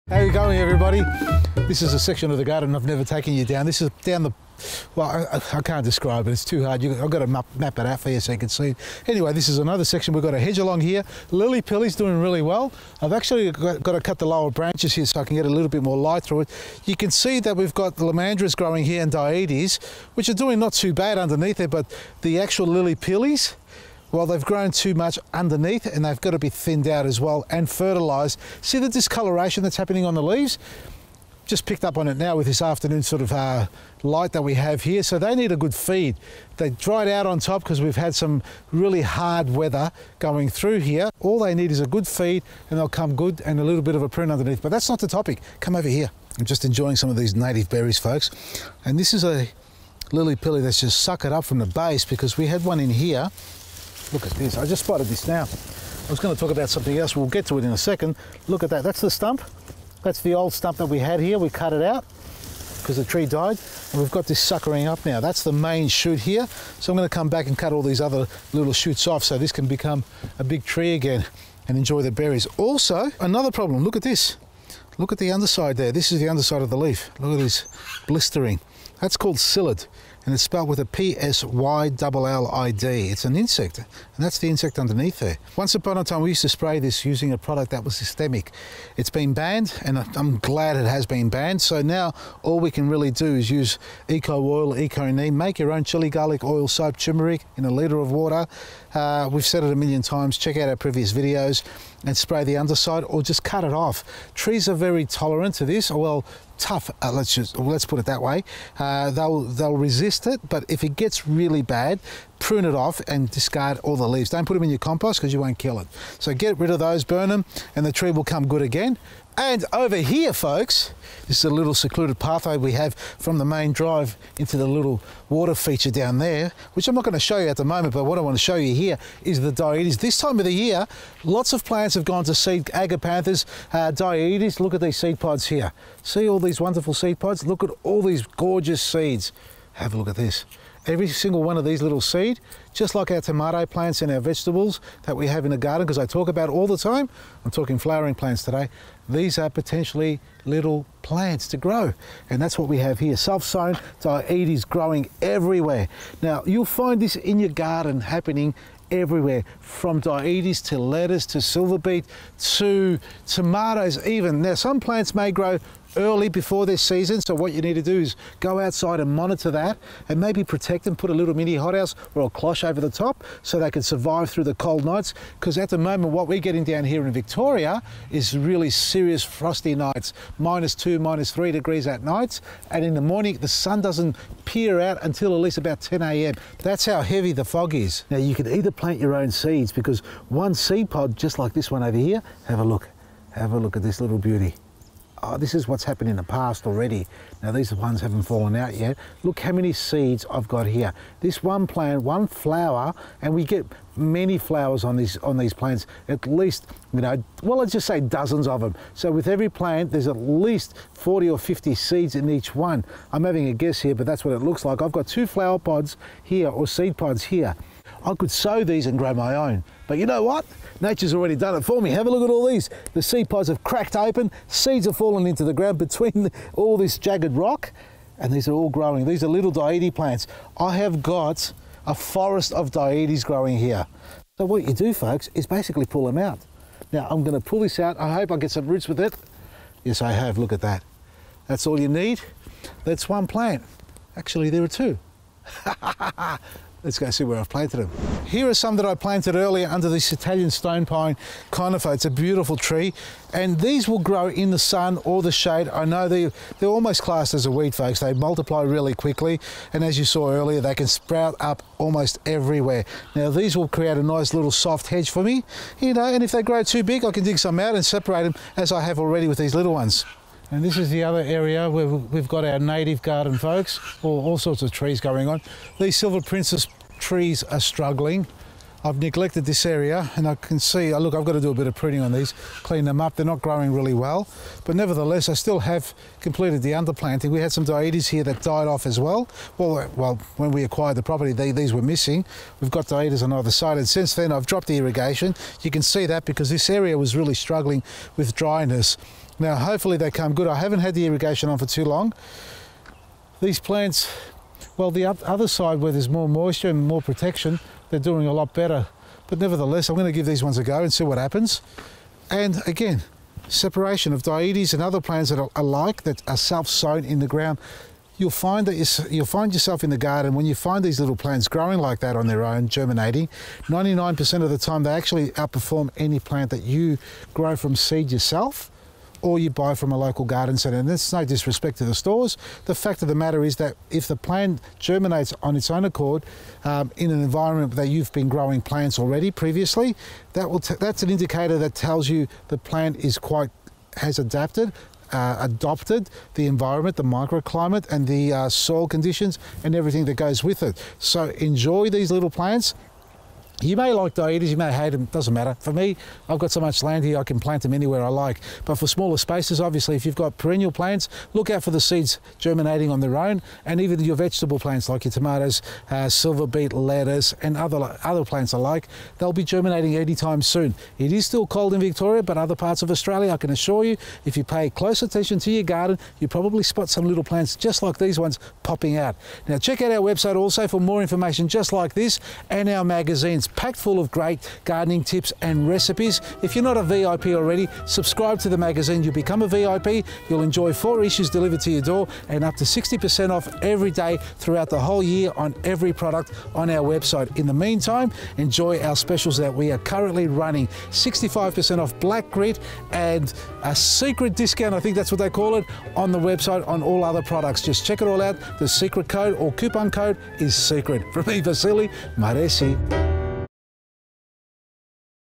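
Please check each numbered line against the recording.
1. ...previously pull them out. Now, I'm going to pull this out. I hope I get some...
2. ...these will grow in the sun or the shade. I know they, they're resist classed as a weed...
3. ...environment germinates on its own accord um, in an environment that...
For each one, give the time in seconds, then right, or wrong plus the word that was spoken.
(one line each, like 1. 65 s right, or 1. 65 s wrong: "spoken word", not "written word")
1. 235 s wrong: "basically", not "previously"
2. 253 s wrong: "almost", not "resist"
3. 334 s wrong: "plant", not "environment".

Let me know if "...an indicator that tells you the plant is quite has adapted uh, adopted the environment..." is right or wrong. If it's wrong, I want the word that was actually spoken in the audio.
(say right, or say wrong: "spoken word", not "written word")
right.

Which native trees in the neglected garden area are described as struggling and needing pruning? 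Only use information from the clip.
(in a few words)
Silver Princess.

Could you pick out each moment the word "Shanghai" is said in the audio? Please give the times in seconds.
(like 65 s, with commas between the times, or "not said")
not said.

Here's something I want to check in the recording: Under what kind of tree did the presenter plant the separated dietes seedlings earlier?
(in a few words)
Italian stone pine conifer.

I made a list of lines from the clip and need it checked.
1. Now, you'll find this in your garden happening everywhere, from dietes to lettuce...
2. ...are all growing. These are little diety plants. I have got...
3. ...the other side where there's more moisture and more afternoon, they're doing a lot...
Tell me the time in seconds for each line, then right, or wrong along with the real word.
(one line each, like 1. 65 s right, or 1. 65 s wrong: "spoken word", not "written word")
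1. 156 s right
2. 228 s right
3. 304 s wrong: "protection", not "afternoon".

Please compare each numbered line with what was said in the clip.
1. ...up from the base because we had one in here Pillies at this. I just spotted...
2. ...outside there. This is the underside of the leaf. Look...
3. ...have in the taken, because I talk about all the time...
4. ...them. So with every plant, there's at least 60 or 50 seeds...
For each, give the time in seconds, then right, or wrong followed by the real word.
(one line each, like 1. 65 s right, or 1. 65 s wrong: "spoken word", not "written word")
1. 51 s wrong: "Look", not "Pillies"
2. 75 s wrong: "underside", not "outside"
3. 145 s wrong: "garden", not "taken"
4. 208 s wrong: "40", not "60".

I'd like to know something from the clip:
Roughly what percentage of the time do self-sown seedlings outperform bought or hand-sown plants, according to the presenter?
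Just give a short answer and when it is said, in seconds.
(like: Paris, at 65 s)
99%, at 323 s.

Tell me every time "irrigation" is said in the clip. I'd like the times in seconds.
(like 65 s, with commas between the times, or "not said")
294 s, 301 s.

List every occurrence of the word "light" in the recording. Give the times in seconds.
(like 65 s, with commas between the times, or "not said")
15 s, 34 s.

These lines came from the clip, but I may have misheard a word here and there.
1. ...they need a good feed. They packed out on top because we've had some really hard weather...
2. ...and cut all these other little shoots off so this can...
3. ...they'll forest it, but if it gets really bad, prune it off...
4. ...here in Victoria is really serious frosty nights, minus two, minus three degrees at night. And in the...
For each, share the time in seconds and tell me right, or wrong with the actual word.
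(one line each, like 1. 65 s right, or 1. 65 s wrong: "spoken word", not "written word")
1. 35 s wrong: "dried", not "packed"
2. 67 s right
3. 109 s wrong: "resist", not "forest"
4. 176 s right.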